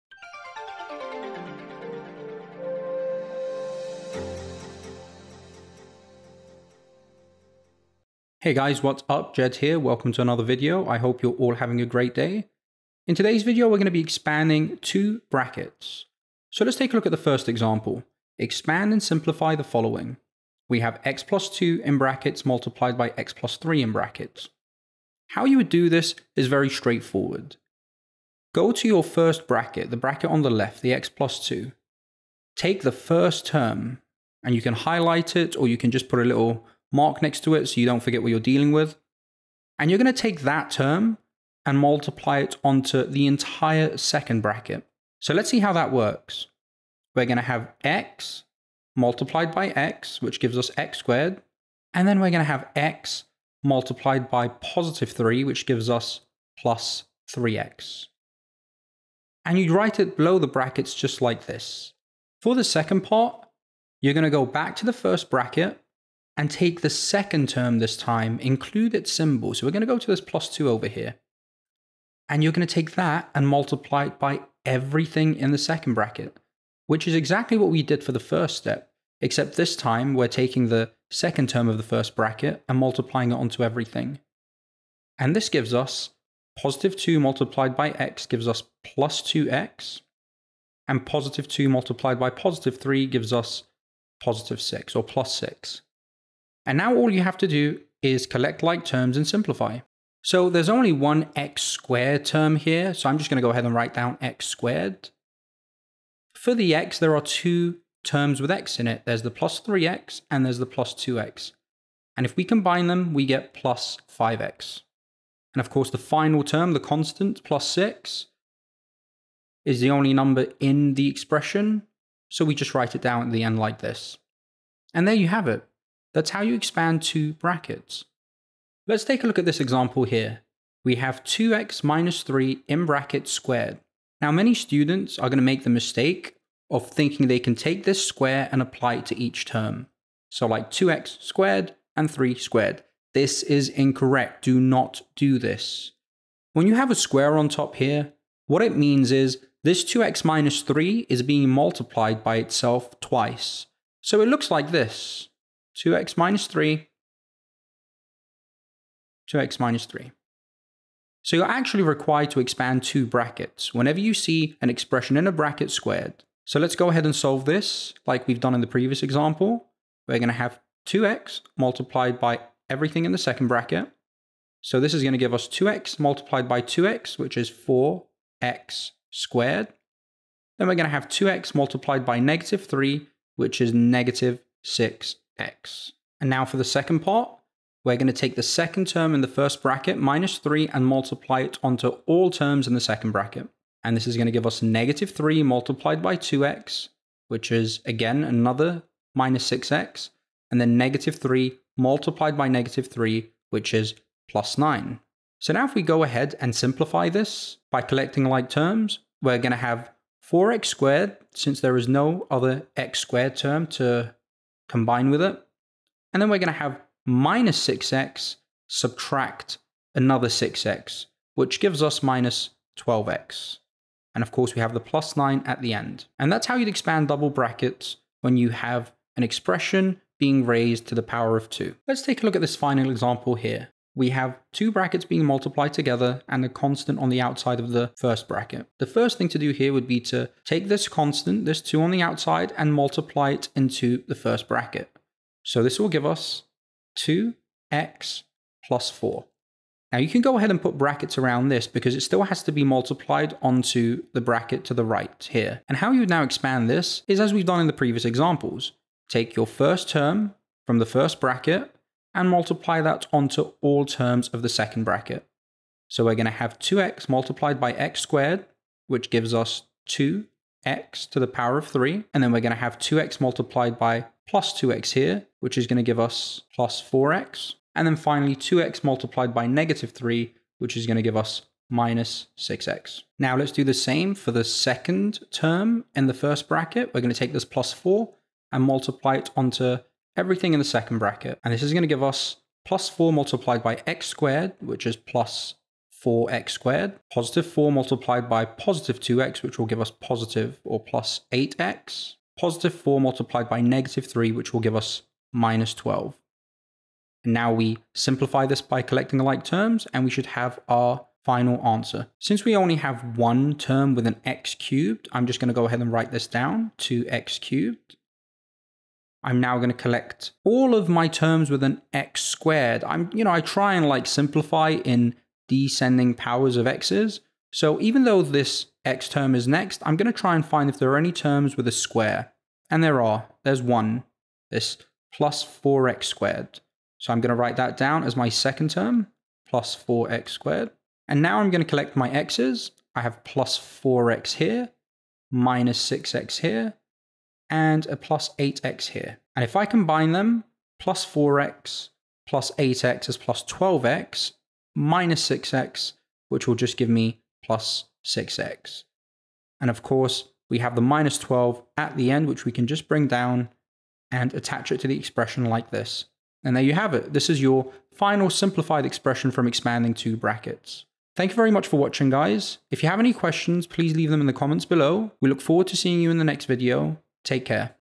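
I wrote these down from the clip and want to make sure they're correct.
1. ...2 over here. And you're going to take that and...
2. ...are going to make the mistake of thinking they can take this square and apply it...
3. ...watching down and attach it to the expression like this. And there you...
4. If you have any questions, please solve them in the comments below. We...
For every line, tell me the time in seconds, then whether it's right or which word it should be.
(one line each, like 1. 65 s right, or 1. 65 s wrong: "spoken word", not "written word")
1. 70 s right
2. 135 s right
3. 362 s wrong: "bring", not "watching"
4. 372 s wrong: "leave", not "solve".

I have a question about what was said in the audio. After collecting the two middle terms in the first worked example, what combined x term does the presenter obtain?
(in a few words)
+5x.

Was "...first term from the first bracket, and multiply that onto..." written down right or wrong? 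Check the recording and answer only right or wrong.
right.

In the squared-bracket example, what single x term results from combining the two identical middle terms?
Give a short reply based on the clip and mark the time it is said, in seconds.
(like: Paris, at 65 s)
-12x, at 222 s.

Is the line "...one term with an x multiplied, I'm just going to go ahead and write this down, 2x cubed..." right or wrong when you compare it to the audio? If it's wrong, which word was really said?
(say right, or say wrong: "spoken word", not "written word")
wrong: "cubed", not "multiplied".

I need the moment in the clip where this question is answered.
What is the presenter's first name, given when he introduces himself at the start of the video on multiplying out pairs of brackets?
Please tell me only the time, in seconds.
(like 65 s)
9 s.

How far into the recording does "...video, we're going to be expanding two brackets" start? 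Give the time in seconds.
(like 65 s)
13 s.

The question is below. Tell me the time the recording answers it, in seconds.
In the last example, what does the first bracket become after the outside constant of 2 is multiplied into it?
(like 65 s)
246 s.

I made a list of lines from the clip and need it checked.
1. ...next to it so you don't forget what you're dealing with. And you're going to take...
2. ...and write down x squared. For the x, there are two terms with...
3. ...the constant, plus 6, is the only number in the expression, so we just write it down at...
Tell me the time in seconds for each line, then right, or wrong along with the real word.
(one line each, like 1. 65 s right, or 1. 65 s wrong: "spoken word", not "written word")
1. 37 s right
2. 103 s right
3. 116 s right.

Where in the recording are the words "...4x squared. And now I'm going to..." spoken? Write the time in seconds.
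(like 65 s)
339 s.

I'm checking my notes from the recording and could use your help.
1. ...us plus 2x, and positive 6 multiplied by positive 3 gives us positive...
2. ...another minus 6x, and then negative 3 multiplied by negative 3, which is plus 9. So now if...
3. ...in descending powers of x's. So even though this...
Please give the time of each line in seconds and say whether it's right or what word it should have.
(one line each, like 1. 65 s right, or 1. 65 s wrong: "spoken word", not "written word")
1. 88 s wrong: "2", not "6"
2. 198 s right
3. 324 s right.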